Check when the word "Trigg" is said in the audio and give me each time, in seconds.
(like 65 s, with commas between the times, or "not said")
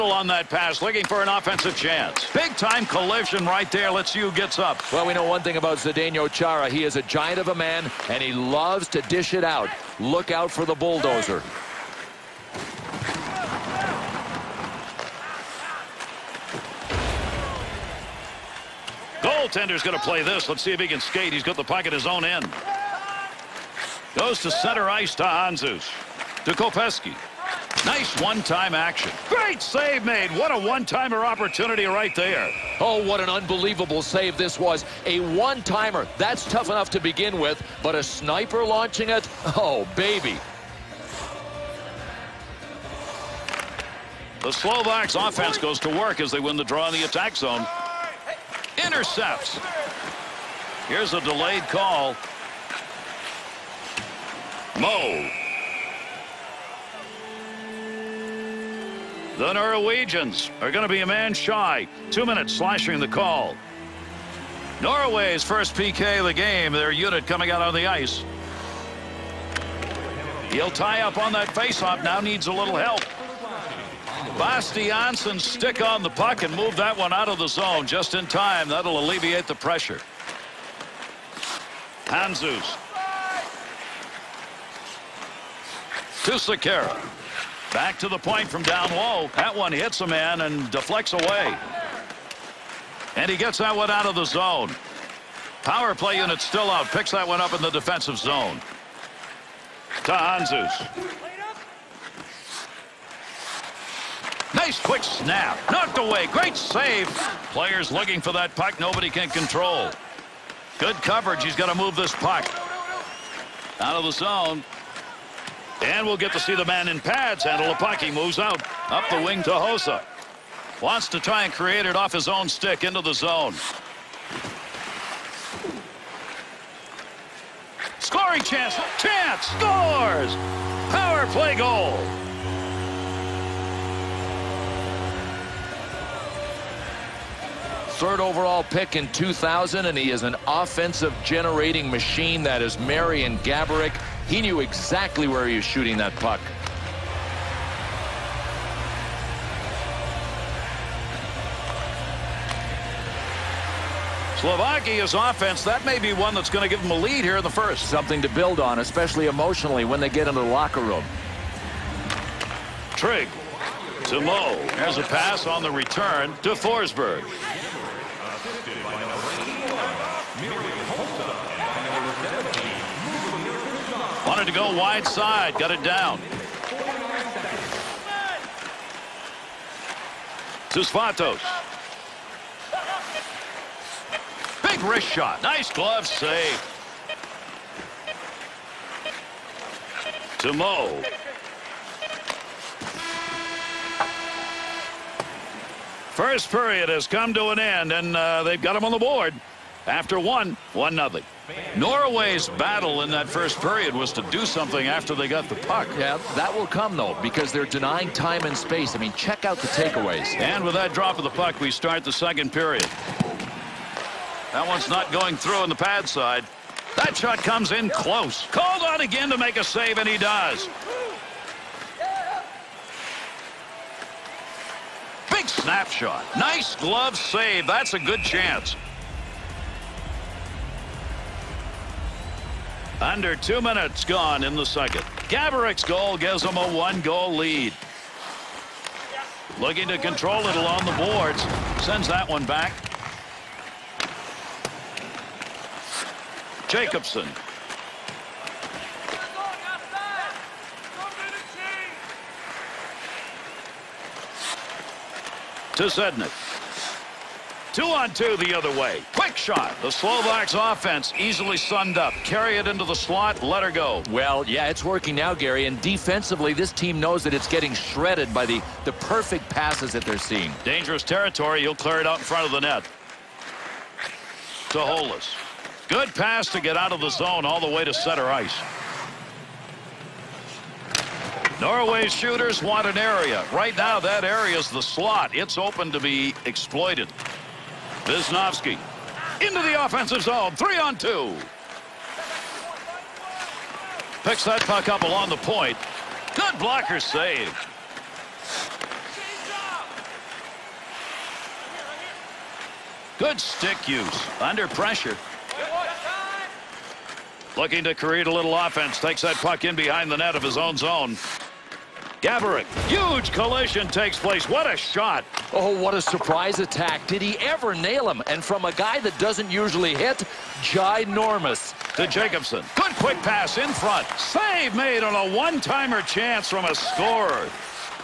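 162 s.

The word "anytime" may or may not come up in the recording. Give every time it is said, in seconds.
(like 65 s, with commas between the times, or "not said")
not said.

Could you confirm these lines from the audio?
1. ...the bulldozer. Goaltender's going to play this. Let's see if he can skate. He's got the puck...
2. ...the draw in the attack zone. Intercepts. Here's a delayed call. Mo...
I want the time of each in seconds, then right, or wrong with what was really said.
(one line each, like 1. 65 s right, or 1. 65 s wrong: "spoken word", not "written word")
1. 10 s right
2. 46 s right.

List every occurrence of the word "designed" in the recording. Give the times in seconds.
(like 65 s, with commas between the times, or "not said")
not said.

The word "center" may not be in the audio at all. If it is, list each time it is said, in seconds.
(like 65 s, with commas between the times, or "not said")
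24 s, 277 s.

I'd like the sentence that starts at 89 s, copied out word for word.
That one hits a man and deflects away.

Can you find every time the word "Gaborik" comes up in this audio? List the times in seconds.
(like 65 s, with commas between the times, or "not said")
143 s, 235 s, 312 s.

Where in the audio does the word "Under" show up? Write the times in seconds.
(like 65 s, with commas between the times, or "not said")
232 s, 304 s.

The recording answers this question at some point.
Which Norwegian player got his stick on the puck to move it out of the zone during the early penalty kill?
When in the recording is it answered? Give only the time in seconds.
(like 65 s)
74 s.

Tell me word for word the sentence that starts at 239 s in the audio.
Looking to control it along the boards.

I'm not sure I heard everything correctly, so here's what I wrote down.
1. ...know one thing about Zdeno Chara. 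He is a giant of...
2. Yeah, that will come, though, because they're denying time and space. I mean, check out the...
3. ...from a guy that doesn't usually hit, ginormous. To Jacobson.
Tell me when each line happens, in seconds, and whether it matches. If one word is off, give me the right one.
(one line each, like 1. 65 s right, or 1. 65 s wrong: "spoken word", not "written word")
1. 5 s right
2. 205 s right
3. 318 s right.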